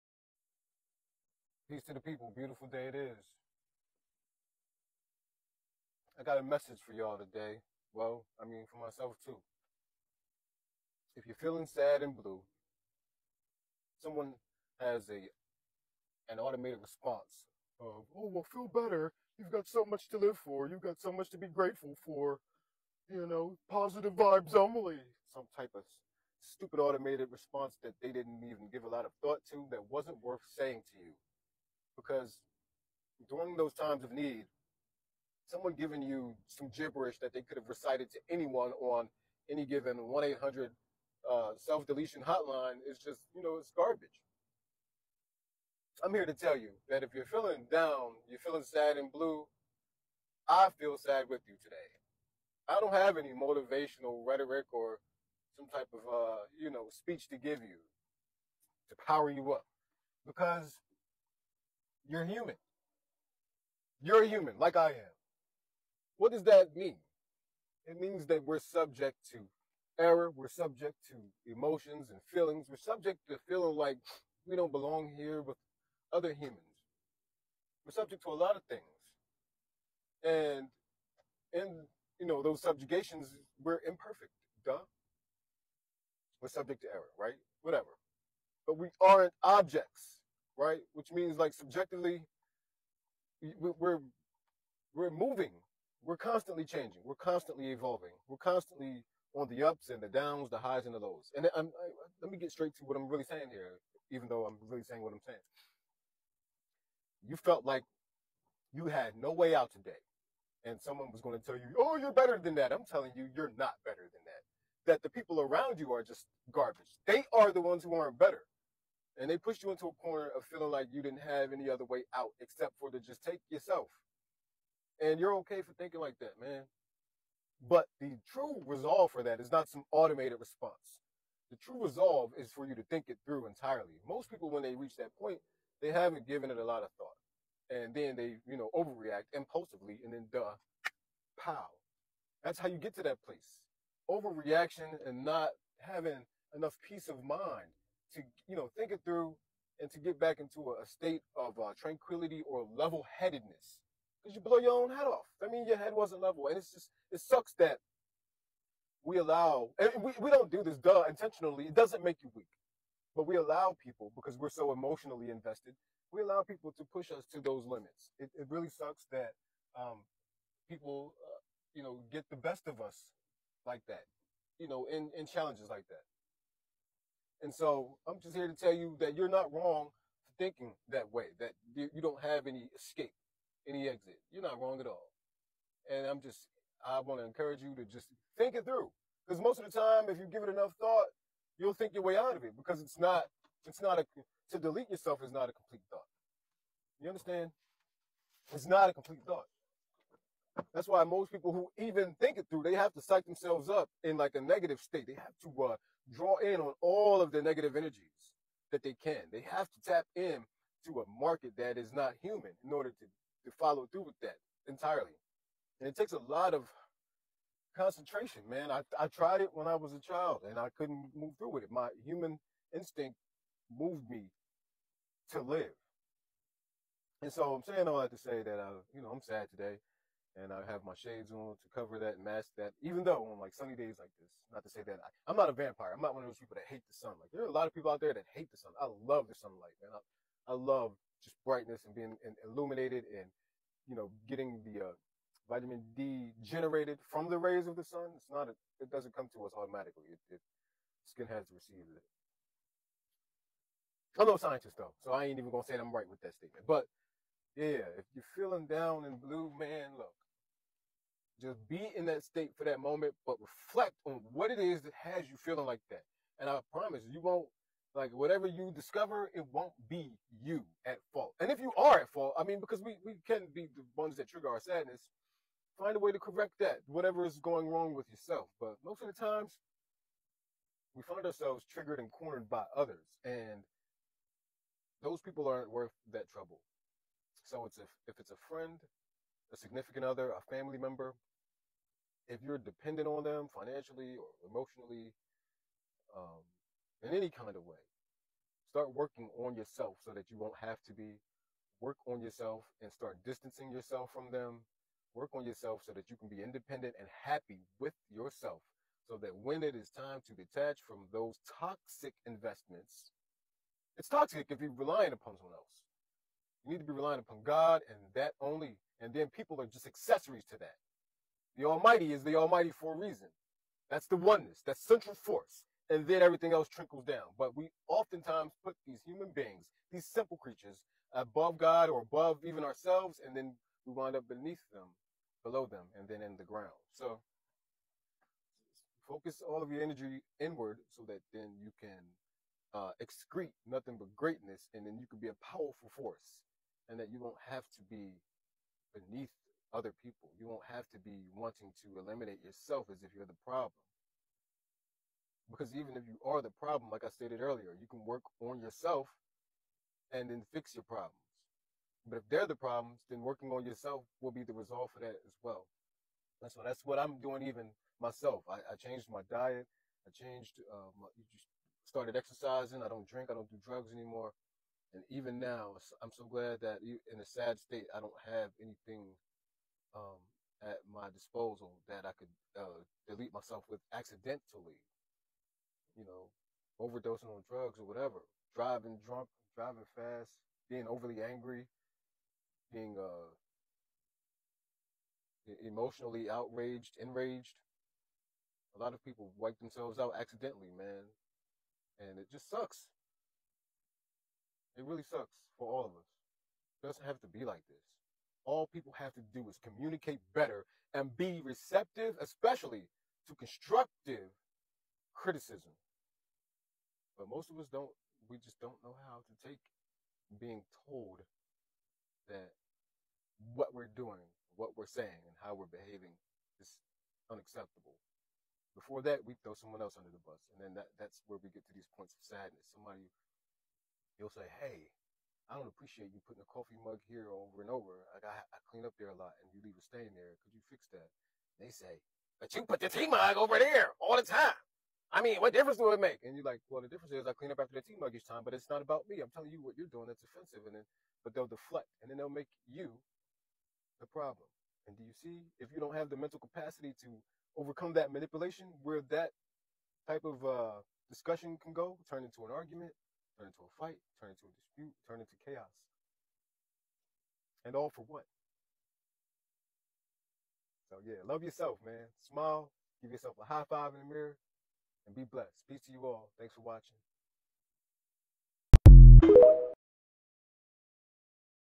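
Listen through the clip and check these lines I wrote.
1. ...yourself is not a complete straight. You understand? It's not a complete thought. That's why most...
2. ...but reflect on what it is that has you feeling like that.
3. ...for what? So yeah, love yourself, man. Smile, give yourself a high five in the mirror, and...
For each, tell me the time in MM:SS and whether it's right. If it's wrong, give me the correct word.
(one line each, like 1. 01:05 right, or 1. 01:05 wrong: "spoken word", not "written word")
1. 03:14 wrong: "thought", not "straight"
2. 04:23 right
3. 07:47 right.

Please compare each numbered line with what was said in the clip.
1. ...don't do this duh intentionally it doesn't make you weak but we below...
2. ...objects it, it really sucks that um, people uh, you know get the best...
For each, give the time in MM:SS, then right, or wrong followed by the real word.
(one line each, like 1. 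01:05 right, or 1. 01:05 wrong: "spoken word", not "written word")
1. 02:40 wrong: "allow", not "below"
2. 02:47 wrong: "limits", not "objects".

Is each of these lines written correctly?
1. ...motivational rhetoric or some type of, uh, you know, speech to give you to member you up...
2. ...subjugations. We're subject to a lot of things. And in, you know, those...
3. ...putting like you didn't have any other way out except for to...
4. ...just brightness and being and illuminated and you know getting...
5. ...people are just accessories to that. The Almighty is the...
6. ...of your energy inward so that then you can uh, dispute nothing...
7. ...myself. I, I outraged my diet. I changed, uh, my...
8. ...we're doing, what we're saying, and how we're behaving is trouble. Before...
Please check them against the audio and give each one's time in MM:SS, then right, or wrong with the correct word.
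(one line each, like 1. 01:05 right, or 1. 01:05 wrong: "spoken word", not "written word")
1. 00:53 wrong: "power", not "member"
2. 01:16 wrong: "humans", not "subjugations"
3. 02:00 wrong: "feeling", not "putting"
4. 04:01 right
5. 05:19 right
6. 05:39 wrong: "excrete", not "dispute"
7. 06:08 wrong: "changed", not "outraged"
8. 07:03 wrong: "unacceptable", not "trouble".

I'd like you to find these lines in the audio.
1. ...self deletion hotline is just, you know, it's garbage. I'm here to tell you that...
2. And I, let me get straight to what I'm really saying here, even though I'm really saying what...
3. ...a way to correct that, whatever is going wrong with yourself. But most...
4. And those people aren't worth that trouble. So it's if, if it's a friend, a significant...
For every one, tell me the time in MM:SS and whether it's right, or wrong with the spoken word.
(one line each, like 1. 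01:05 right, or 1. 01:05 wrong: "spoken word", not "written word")
1. 00:41 right
2. 01:41 right
3. 04:35 right
4. 04:43 right.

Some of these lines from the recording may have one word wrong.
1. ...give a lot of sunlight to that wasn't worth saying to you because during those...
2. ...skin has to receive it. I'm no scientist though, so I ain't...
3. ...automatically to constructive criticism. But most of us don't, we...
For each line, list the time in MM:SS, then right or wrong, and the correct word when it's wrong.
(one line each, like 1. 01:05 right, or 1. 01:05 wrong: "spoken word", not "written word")
1. 00:28 wrong: "thought", not "sunlight"
2. 04:11 right
3. 06:52 wrong: "especially", not "automatically".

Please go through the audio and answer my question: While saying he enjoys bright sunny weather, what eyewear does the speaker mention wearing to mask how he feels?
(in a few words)
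shades.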